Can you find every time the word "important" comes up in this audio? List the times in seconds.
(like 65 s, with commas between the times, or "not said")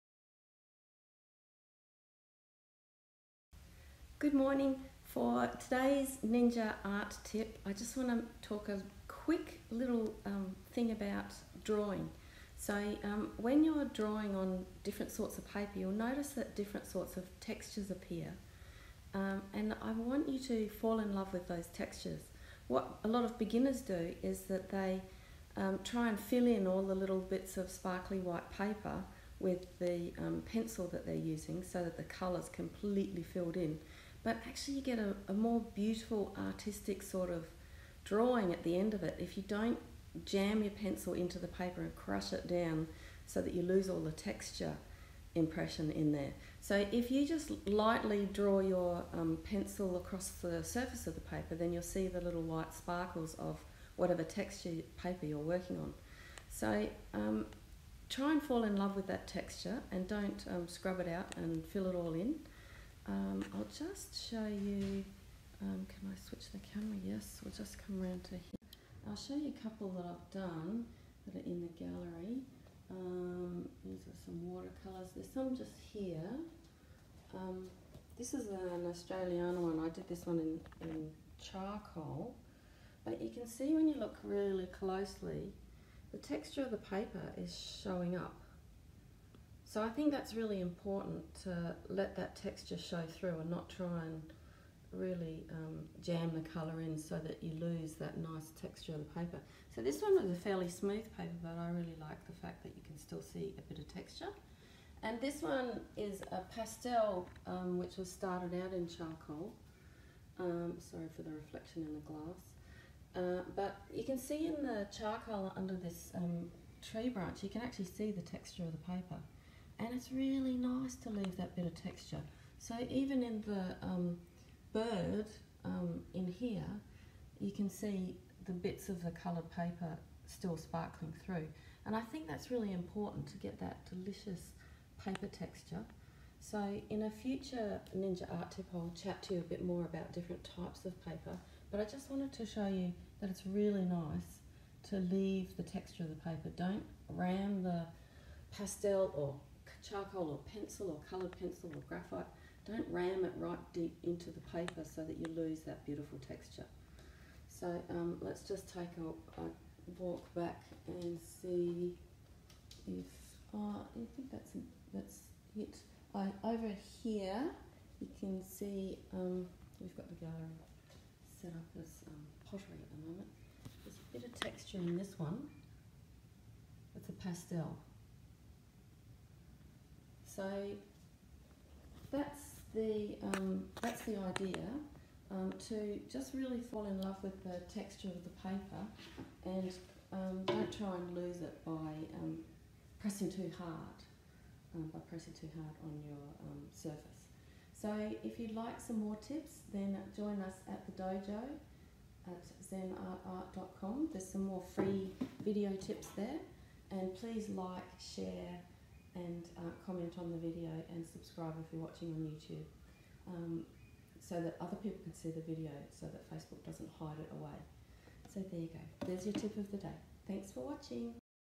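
90 s, 132 s.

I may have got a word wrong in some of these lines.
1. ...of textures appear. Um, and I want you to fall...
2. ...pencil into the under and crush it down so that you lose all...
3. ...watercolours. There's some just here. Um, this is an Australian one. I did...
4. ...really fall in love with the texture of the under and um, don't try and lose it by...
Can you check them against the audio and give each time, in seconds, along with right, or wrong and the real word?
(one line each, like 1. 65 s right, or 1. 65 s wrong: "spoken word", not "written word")
1. 17 s right
2. 40 s wrong: "paper", not "under"
3. 74 s right
4. 186 s wrong: "paper", not "under".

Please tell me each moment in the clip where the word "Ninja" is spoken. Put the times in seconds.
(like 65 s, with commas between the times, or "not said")
6 s, 137 s.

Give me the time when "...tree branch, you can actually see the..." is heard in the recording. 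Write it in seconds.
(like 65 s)
116 s.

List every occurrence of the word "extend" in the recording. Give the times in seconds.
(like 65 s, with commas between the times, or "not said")
not said.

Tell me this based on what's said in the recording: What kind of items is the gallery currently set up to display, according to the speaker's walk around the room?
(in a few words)
pottery.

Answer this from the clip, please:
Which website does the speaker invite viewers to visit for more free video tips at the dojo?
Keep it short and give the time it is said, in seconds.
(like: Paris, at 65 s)
zenartart.com, at 202 s.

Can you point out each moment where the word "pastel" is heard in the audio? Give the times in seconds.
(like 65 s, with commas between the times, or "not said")
106 s, 148 s, 177 s.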